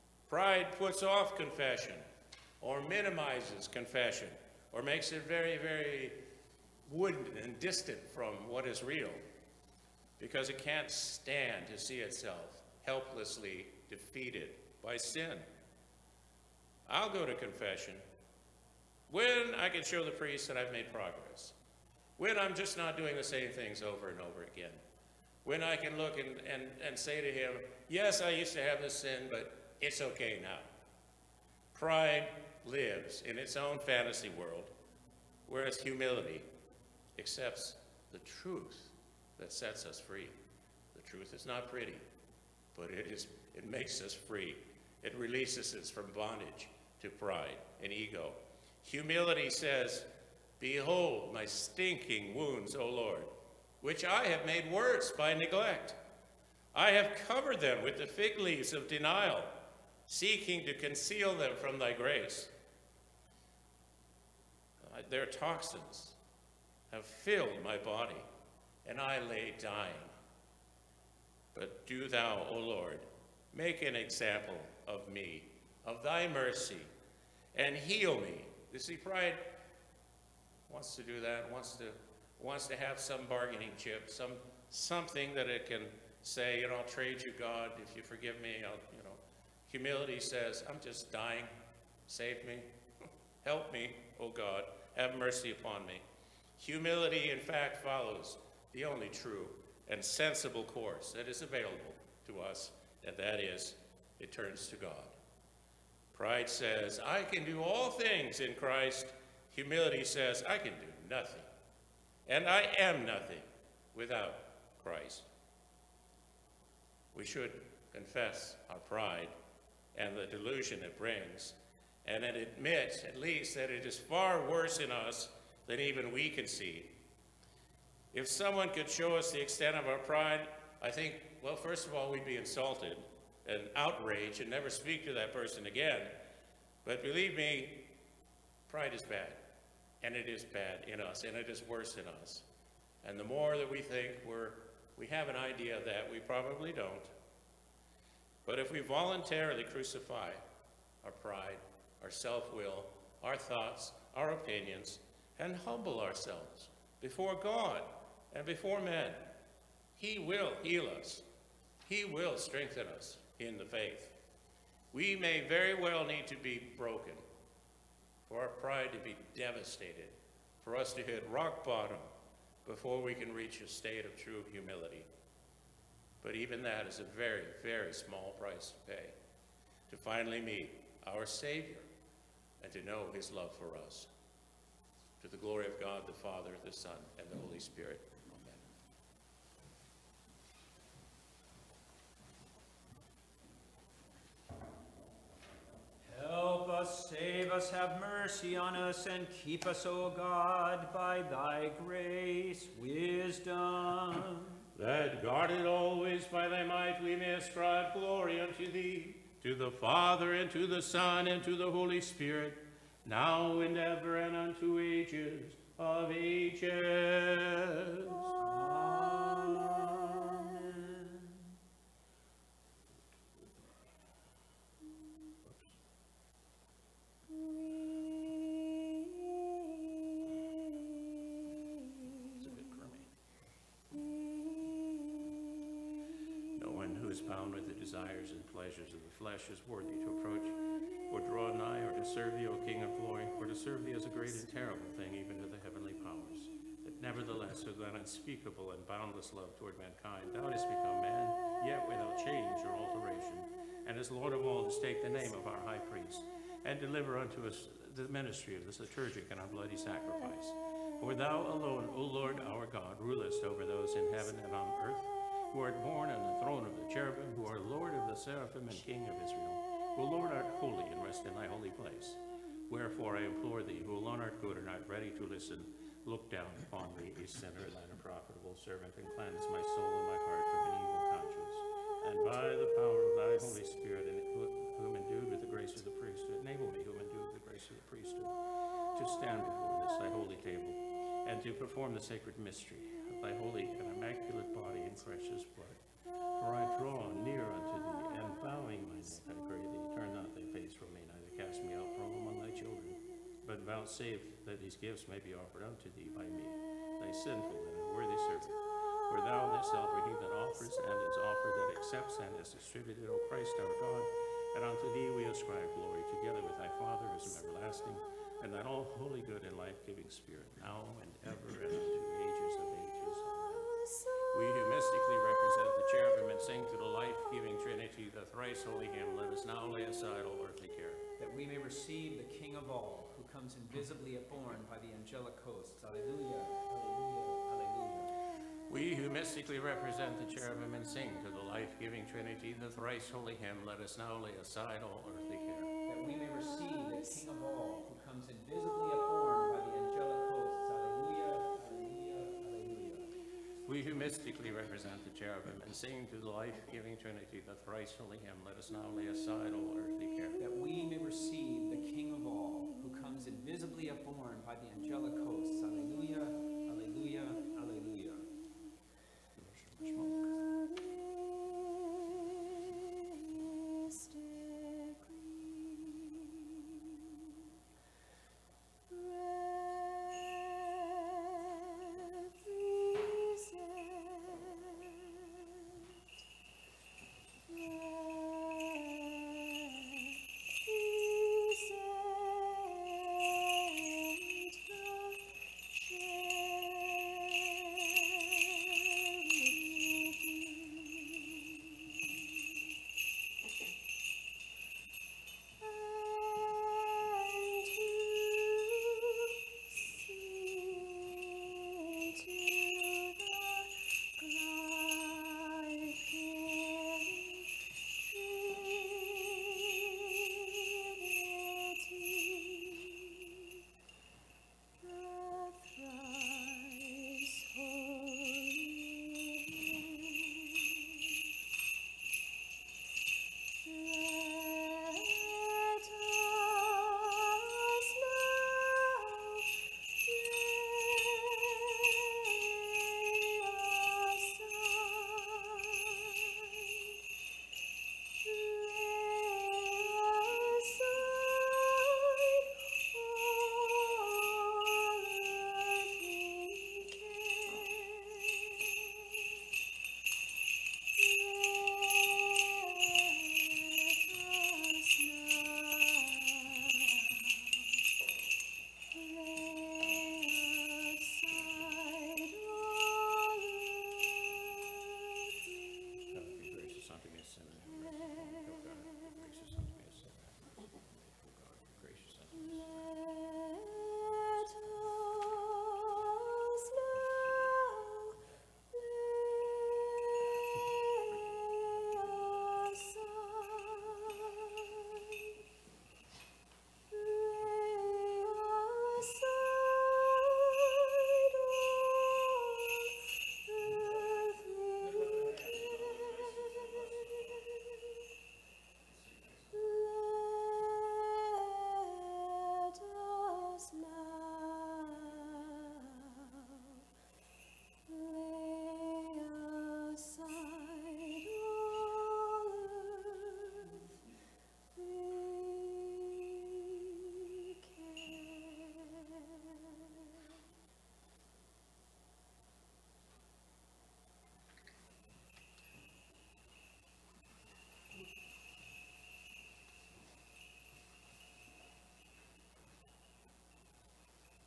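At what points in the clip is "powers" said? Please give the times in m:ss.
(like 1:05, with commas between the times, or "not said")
4:06, 4:42.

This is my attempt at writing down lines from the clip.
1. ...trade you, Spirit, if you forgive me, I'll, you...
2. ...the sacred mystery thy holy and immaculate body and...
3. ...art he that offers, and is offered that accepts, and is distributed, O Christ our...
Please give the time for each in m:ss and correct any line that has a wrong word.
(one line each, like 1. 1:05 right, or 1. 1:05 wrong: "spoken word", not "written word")
1. 1:26 wrong: "God", not "Spirit"
2. 4:51 right
3. 5:09 right.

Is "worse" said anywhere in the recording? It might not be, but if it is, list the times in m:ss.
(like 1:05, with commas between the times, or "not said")
0:54, 2:04, 2:21.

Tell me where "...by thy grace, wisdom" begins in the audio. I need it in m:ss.
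3:20.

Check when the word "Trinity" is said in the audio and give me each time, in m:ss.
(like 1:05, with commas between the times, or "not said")
5:27, 5:42, 5:56.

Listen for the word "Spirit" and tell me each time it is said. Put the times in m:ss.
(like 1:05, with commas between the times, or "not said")
3:07, 3:31, 4:43, 5:20.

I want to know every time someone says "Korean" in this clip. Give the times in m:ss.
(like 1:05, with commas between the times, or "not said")
not said.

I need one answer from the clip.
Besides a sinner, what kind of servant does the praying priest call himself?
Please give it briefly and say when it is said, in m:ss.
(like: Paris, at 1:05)
Unprofitable, at 4:37.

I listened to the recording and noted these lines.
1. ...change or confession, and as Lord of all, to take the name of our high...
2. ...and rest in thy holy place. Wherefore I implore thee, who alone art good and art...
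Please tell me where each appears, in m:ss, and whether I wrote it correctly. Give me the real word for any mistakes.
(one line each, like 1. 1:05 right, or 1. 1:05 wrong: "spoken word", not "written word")
1. 4:12 wrong: "alteration", not "confession"
2. 4:30 right.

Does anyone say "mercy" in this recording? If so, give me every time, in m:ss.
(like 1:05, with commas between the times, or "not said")
1:16, 1:35, 3:17.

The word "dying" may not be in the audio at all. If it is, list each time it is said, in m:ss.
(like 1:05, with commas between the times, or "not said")
1:09, 1:31.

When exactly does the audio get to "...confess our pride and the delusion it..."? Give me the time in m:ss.
1:57.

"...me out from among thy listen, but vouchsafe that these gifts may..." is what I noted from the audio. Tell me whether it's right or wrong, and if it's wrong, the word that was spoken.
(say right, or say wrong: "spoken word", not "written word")
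wrong: "children", not "listen".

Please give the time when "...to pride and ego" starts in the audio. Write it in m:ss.
0:47.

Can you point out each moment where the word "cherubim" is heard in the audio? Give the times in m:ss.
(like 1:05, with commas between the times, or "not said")
4:26, 5:25, 5:40, 5:55.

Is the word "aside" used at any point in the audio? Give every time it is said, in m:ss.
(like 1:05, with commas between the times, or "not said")
5:29, 5:44, 5:59.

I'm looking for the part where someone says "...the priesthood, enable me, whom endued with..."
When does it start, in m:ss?
4:45.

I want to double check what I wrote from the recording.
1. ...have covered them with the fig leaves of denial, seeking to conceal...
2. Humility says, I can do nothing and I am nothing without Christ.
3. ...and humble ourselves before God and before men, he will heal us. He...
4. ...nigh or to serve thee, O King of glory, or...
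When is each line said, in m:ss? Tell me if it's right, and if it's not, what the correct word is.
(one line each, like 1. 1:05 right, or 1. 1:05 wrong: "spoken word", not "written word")
1. 0:56 right
2. 1:49 right
3. 2:35 right
4. 4:01 right.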